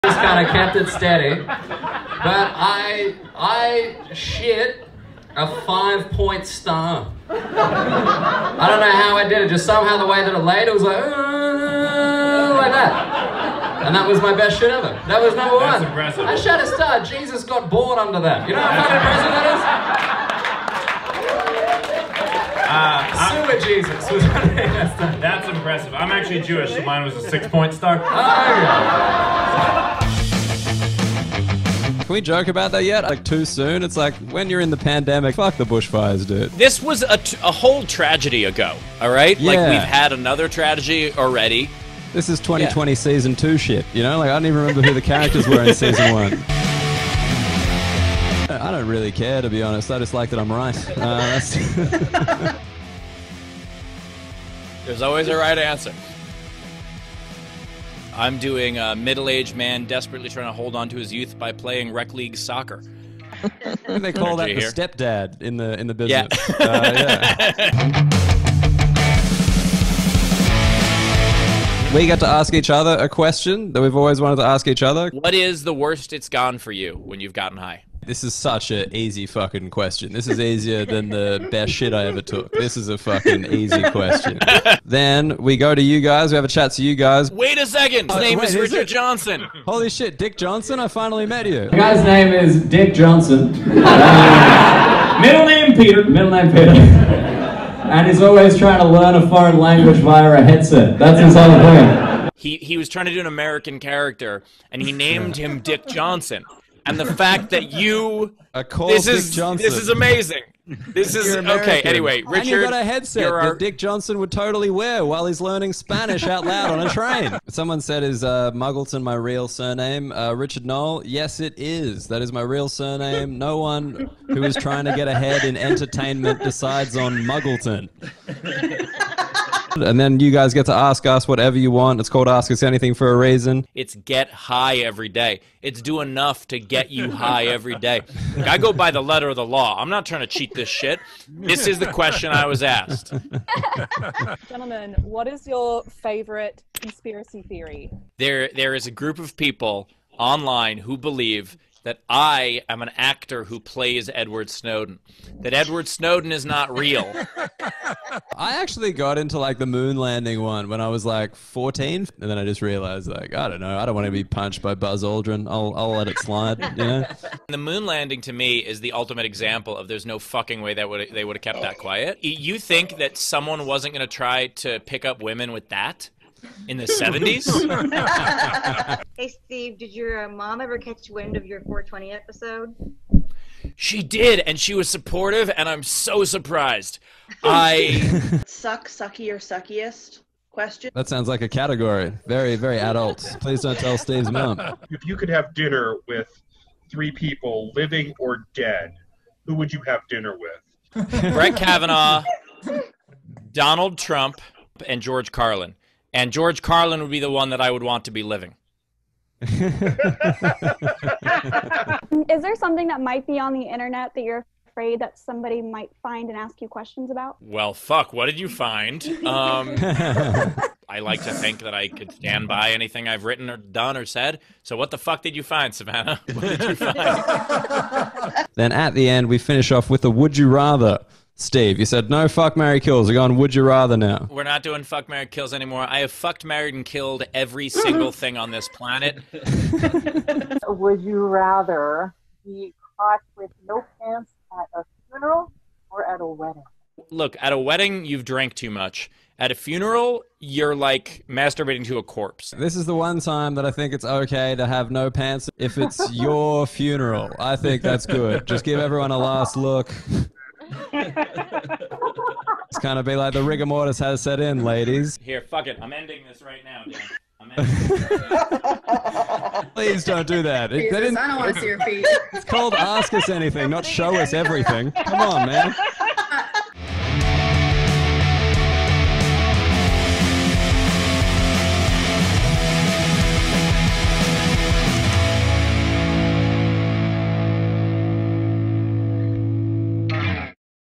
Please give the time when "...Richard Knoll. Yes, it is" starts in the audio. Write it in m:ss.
2:00.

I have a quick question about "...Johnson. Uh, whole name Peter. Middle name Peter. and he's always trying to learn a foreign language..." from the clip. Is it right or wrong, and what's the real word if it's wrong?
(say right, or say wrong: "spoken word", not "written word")
wrong: "middle", not "whole".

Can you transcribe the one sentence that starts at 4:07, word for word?
Look, at a wedding you've drank too much.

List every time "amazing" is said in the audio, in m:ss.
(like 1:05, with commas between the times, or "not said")
1:49.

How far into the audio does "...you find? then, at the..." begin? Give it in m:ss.
3:46.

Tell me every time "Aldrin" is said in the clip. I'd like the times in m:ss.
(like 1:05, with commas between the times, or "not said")
2:45.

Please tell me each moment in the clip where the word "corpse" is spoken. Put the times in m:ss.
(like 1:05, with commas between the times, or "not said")
4:12.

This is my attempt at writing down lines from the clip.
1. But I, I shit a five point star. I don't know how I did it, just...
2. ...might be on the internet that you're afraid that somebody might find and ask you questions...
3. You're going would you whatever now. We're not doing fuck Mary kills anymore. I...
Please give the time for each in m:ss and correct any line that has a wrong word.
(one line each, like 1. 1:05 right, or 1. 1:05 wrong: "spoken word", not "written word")
1. 0:01 right
2. 3:33 right
3. 3:53 wrong: "rather", not "whatever".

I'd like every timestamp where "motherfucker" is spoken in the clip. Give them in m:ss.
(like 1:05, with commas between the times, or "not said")
not said.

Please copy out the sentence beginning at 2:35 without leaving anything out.
That Edward Snowden is not real.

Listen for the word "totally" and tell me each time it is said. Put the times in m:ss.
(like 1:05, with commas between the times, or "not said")
1:54.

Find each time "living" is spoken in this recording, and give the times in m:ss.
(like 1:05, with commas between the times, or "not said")
3:17, 3:28.